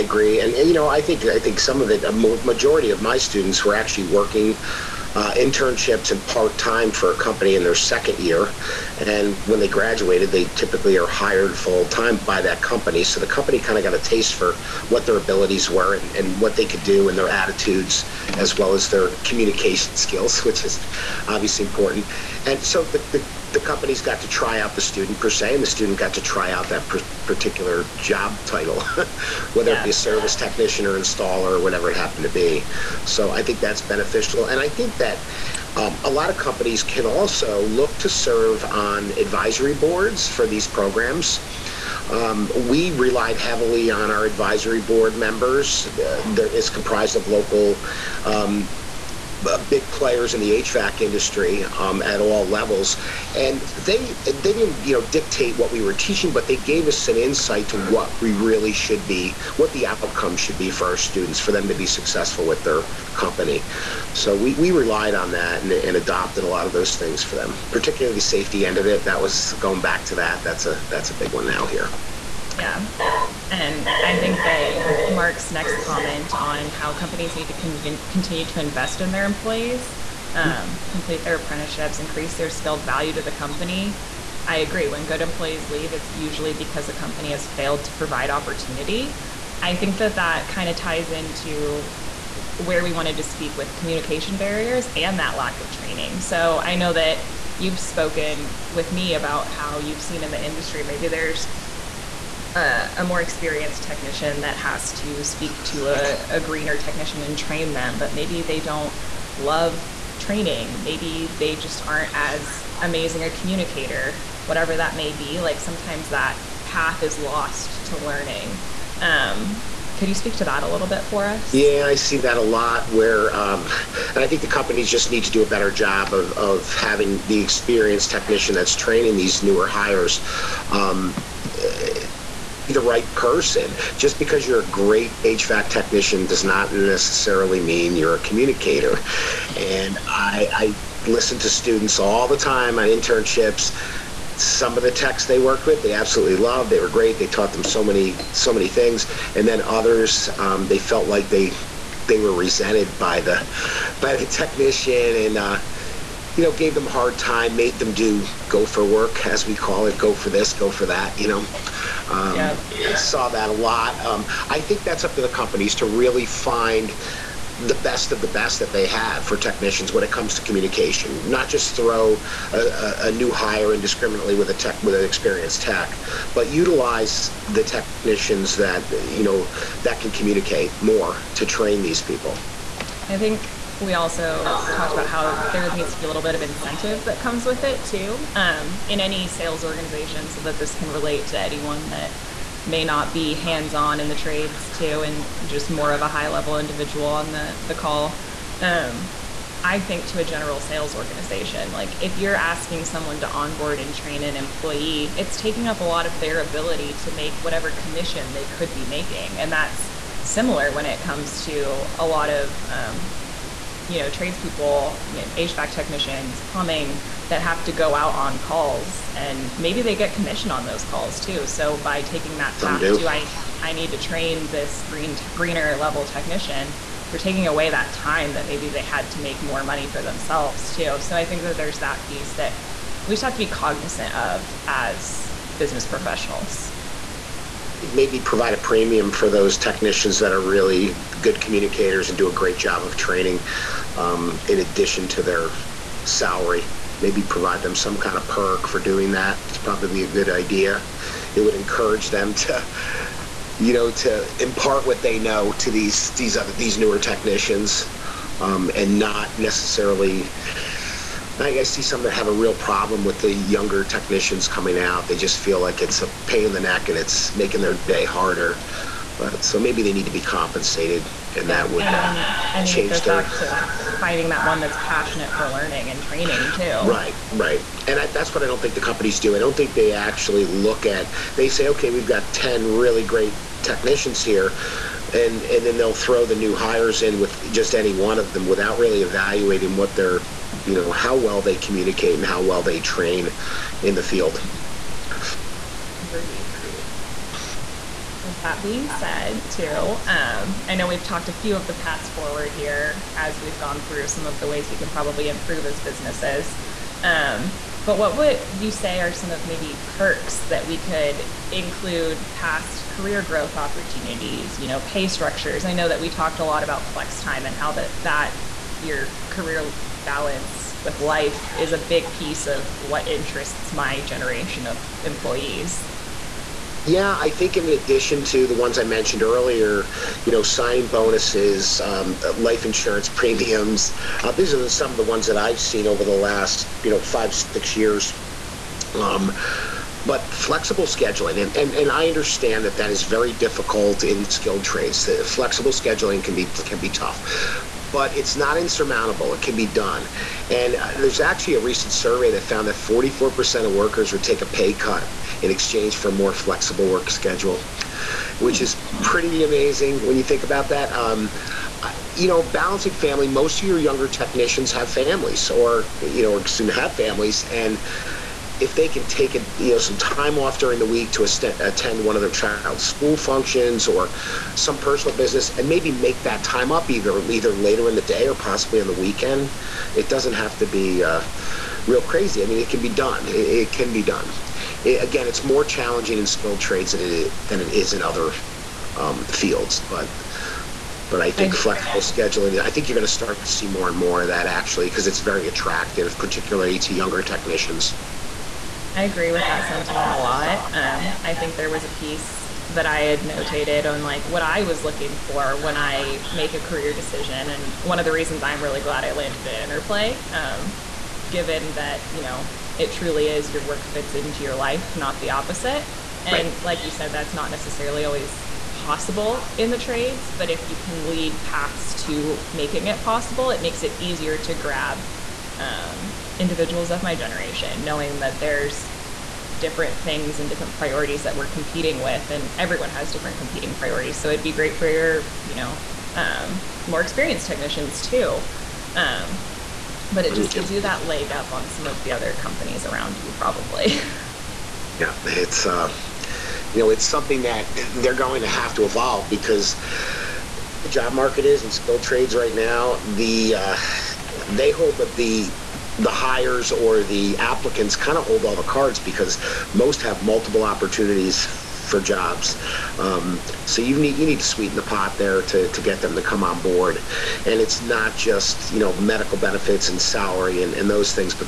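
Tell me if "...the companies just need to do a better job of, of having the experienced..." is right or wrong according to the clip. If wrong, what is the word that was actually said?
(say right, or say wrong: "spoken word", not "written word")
right.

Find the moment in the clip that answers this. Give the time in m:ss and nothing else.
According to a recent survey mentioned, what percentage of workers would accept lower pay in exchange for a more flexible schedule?
5:52.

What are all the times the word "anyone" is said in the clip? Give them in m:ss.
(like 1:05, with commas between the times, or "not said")
3:11.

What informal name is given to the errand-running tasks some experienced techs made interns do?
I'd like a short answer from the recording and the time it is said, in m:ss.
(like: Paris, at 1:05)
go for work, at 2:38.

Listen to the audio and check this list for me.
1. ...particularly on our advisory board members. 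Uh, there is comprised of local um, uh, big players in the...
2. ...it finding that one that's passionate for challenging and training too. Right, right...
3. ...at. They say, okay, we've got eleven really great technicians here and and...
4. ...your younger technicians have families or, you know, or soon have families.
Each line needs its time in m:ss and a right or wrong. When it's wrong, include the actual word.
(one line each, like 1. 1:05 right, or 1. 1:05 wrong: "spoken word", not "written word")
1. 0:43 wrong: "heavily", not "particularly"
2. 4:32 wrong: "learning", not "challenging"
3. 4:40 wrong: "ten", not "eleven"
4. 6:03 right.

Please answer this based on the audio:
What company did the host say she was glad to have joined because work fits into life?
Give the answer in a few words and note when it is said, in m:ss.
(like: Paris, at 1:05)
Interplay, at 6:49.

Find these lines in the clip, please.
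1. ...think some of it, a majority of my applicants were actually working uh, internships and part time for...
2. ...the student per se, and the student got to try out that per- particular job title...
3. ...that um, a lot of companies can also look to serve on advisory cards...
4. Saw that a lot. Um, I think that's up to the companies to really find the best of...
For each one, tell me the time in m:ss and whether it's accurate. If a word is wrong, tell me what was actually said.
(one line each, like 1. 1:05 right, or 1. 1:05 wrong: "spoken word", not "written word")
1. 0:01 wrong: "students", not "applicants"
2. 0:24 right
3. 0:34 wrong: "boards", not "cards"
4. 2:42 right.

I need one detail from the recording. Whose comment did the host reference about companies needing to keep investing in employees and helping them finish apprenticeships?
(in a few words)
Mark.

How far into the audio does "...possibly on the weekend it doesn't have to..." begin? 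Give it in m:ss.
6:18.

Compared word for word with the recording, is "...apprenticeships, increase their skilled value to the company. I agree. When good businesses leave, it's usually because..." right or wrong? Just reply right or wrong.
wrong.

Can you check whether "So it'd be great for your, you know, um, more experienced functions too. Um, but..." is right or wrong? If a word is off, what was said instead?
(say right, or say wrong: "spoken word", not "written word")
wrong: "technicians", not "functions".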